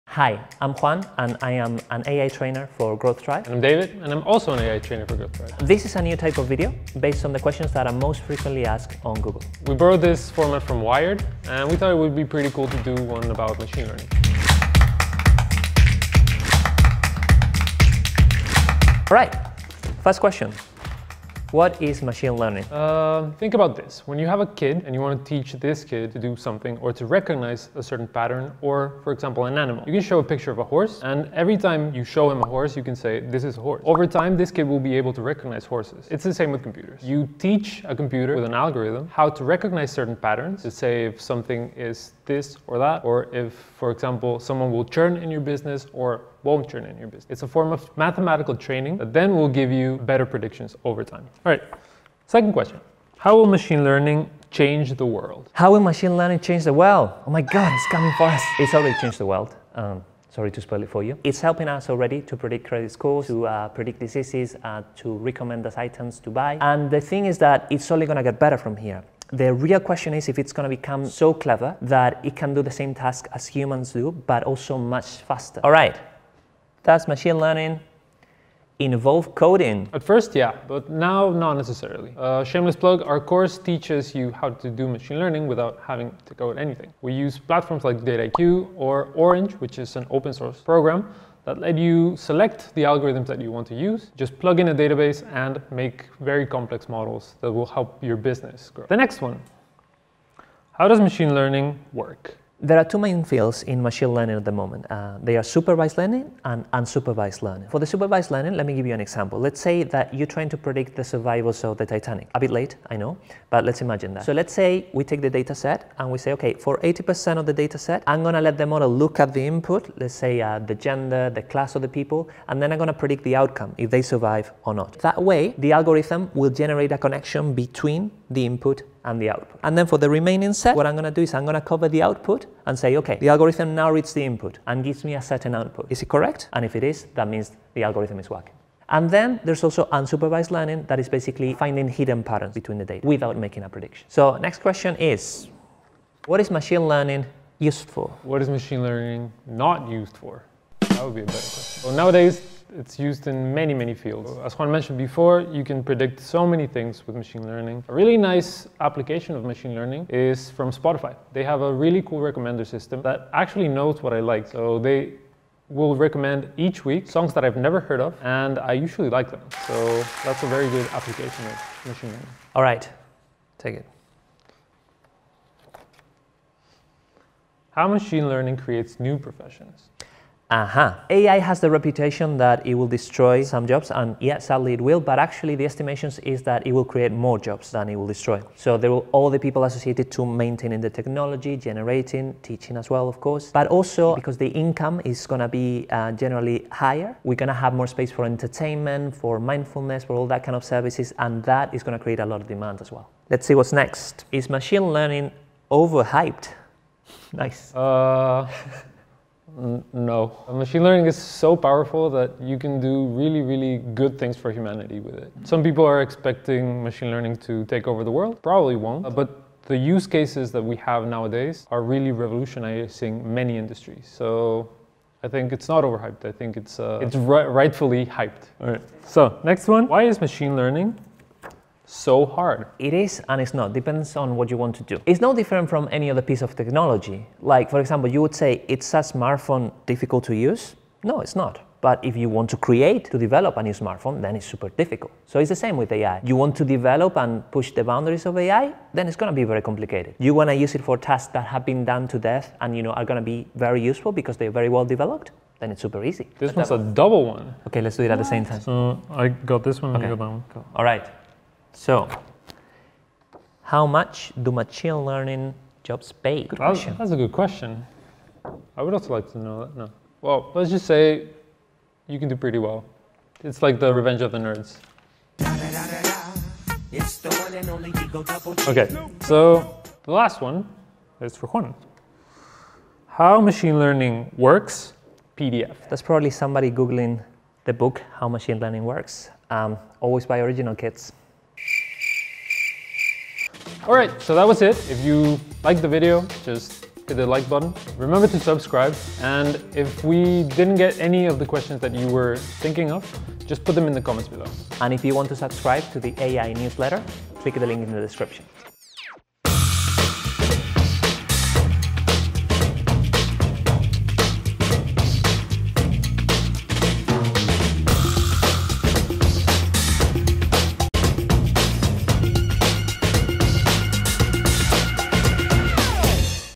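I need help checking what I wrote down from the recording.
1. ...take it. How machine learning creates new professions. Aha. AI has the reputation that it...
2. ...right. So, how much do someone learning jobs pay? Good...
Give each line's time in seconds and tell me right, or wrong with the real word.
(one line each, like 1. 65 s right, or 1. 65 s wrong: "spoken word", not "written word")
1. 173 s right
2. 260 s wrong: "machine", not "someone".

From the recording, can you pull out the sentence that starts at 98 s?
The next one, how does machine learning work?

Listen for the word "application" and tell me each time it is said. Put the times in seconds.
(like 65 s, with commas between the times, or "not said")
158 s, 170 s.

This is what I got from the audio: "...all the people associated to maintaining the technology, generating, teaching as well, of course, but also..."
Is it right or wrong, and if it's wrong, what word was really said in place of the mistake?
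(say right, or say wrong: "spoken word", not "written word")
right.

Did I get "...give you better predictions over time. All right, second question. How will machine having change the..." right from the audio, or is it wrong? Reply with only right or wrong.
wrong.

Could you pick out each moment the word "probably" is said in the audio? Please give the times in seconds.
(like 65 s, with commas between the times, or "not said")
218 s, 286 s.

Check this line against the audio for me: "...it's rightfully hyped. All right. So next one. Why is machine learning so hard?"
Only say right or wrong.
right.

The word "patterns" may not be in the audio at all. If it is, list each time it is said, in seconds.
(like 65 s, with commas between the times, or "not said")
28 s, 40 s, 142 s.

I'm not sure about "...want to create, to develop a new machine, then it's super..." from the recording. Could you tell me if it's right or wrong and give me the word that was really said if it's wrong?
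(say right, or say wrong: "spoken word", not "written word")
wrong: "smartphone", not "machine".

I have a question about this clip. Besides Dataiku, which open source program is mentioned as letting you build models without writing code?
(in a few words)
Orange.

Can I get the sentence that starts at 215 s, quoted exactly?
Some people are expecting machine learning to take over the world.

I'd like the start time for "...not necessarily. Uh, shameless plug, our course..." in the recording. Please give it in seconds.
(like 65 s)
81 s.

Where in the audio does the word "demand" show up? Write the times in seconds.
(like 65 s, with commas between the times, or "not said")
202 s.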